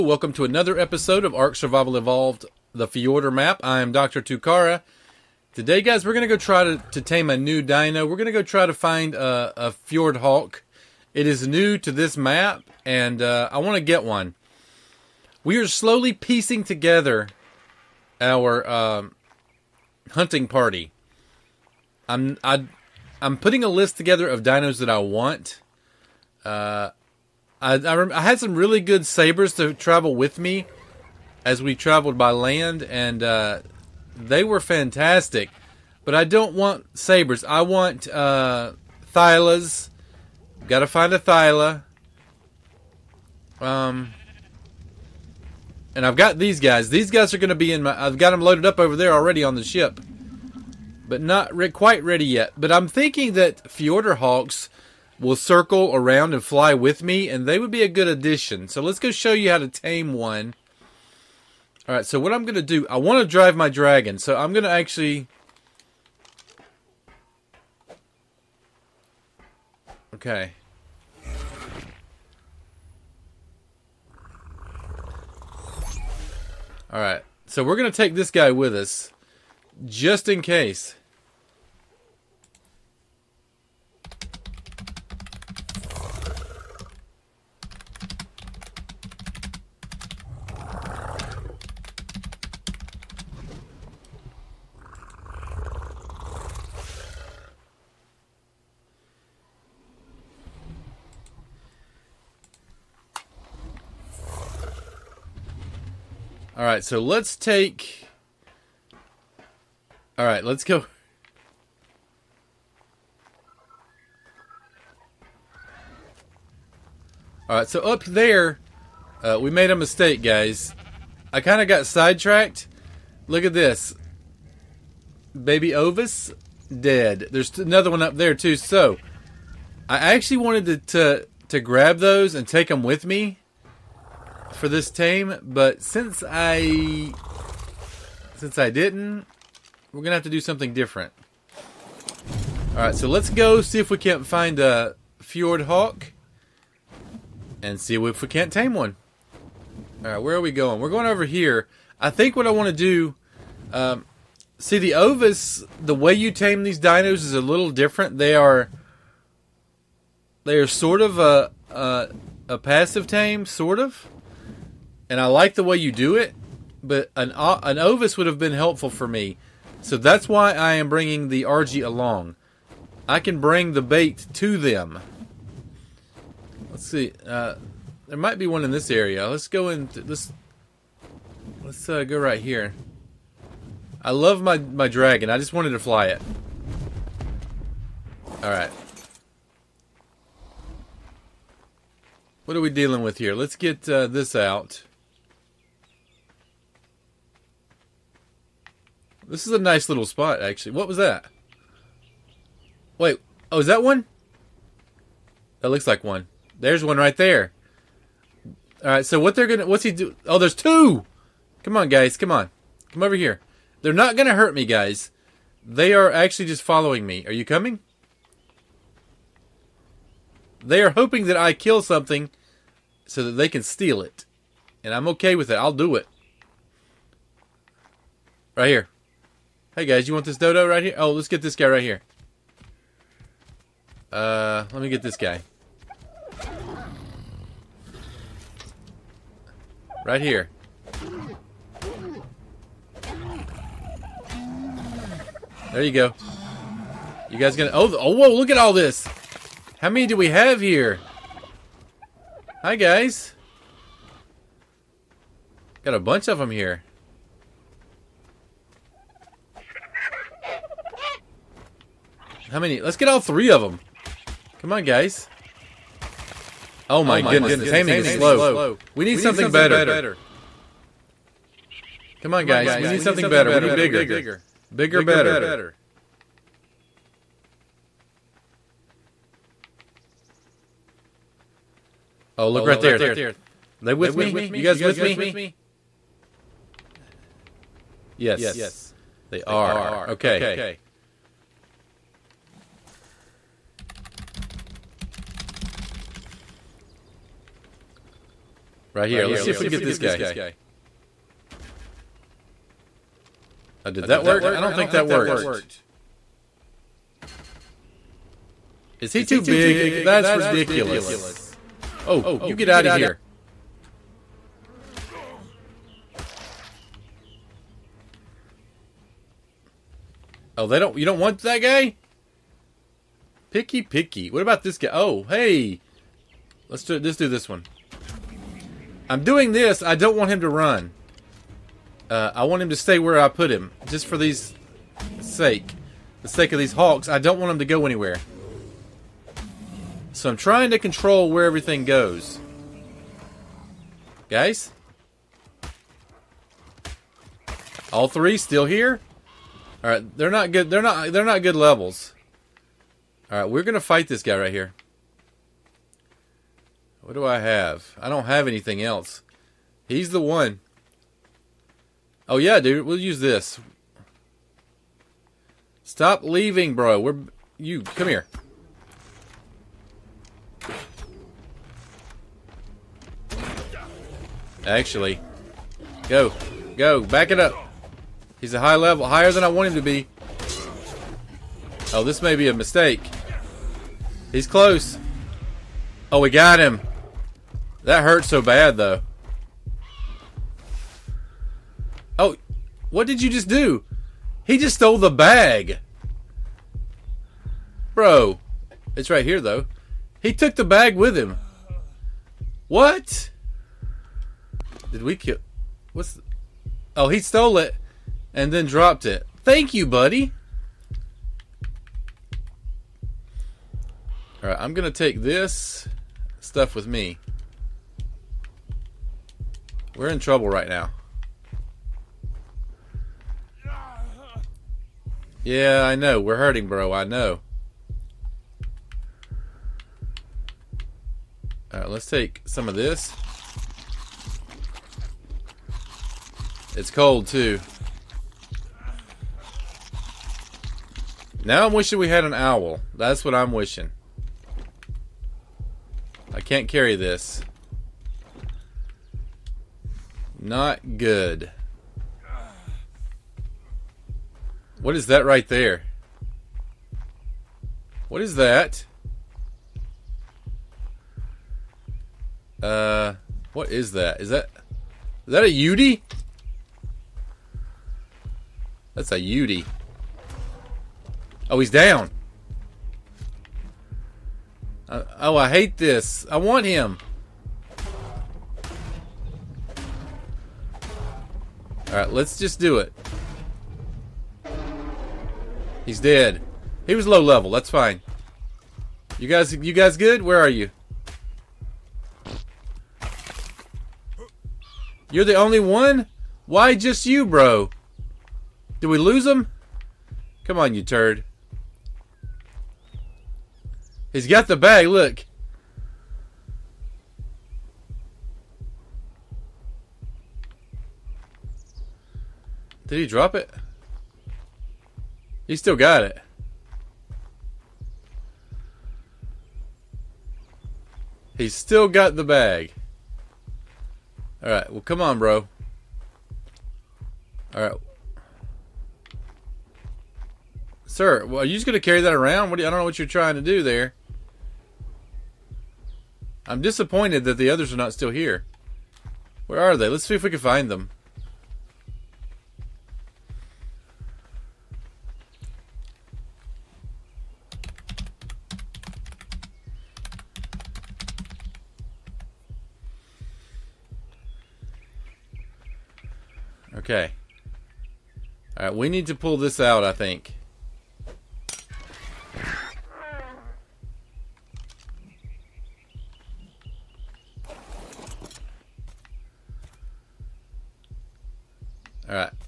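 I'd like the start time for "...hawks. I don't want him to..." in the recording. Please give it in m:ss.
5:36.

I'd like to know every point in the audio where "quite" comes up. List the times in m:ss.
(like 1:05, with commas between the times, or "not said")
0:51.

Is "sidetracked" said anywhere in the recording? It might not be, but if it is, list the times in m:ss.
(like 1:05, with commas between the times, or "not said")
2:01.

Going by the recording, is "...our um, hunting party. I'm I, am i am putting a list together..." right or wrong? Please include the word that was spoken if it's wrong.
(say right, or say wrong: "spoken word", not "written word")
right.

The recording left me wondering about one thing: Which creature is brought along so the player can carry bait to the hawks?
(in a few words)
Argy.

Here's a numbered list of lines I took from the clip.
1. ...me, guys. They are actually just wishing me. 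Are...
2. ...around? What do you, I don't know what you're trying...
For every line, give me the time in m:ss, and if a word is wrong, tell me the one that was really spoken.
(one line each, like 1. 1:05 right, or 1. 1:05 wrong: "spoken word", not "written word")
1. 3:34 wrong: "following", not "wishing"
2. 8:52 right.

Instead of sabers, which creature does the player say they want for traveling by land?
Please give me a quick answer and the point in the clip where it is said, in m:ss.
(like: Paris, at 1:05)
Thylas, at 0:39.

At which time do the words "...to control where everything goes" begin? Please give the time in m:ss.
5:40.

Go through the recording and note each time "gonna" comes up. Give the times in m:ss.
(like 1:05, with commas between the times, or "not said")
2:20, 3:29, 3:34, 4:07, 5:53.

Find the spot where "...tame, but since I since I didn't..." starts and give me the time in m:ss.
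2:14.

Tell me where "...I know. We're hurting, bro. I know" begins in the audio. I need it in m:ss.
7:05.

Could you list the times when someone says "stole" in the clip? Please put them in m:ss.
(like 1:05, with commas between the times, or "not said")
6:34, 6:47.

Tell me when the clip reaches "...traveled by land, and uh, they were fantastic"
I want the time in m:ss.
0:31.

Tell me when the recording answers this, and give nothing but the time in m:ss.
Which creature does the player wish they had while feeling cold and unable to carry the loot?
7:22.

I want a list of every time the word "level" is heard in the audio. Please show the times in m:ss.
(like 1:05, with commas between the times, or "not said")
5:51, 6:18, 8:07.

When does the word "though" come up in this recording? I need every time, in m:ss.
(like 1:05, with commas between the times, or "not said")
6:28, 6:39.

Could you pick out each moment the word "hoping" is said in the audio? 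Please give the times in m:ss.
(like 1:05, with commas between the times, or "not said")
3:40.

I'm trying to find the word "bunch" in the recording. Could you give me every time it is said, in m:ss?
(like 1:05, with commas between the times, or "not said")
4:15.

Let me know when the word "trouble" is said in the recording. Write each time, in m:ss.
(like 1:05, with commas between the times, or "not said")
7:00.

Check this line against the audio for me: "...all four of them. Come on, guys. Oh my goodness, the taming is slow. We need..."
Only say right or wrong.
wrong.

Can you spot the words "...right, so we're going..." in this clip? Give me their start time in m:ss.
1:16.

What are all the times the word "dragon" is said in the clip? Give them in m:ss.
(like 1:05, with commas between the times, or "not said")
1:03, 3:04.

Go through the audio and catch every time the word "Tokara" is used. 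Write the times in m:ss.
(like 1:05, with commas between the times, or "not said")
0:04.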